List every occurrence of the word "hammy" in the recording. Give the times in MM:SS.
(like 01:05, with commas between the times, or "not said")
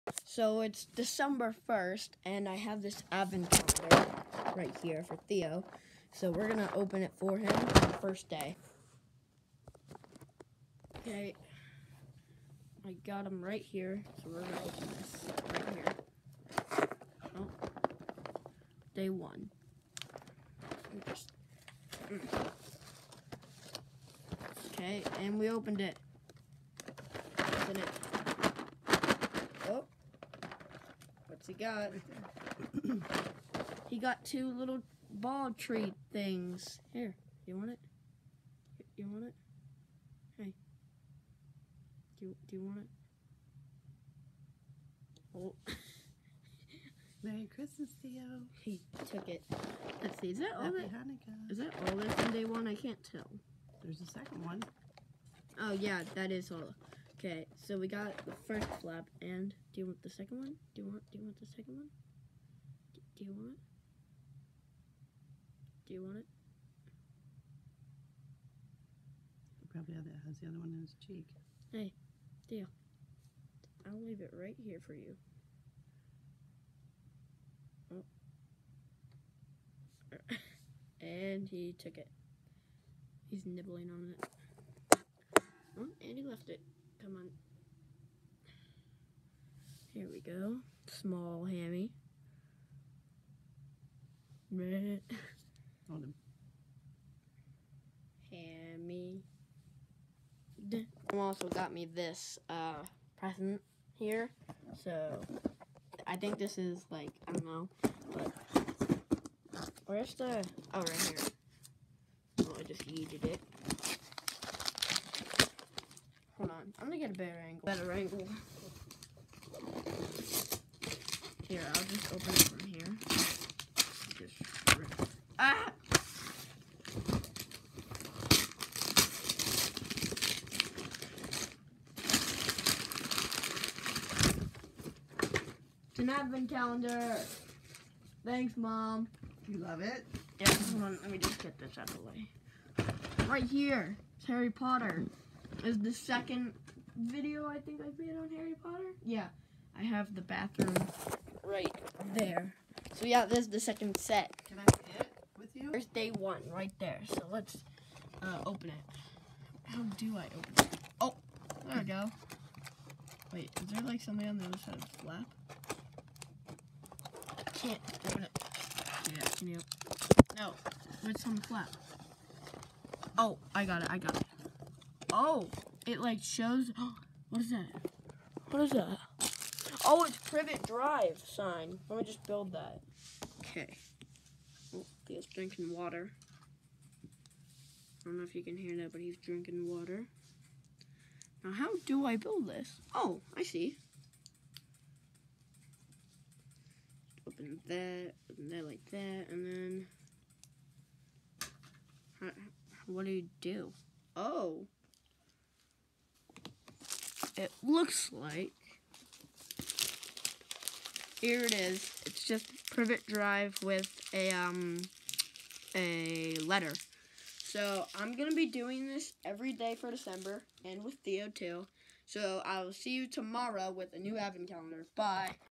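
01:31, 01:38.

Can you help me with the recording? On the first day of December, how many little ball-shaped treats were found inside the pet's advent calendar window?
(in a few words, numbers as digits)
2.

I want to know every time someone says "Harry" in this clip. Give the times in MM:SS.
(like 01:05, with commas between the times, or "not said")
02:24, 02:28.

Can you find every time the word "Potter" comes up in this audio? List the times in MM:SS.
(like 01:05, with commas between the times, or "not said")
02:24, 02:28.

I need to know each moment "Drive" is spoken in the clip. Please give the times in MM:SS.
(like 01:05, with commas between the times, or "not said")
03:00, 03:33.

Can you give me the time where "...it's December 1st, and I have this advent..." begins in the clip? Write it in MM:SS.
00:00.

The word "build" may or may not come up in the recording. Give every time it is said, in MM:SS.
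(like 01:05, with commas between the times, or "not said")
03:02, 03:12.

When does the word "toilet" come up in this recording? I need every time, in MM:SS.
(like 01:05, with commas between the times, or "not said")
not said.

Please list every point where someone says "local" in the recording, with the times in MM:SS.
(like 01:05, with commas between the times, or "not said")
not said.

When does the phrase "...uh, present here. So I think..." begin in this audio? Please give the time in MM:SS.
01:42.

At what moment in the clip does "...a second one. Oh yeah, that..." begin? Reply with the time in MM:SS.
00:54.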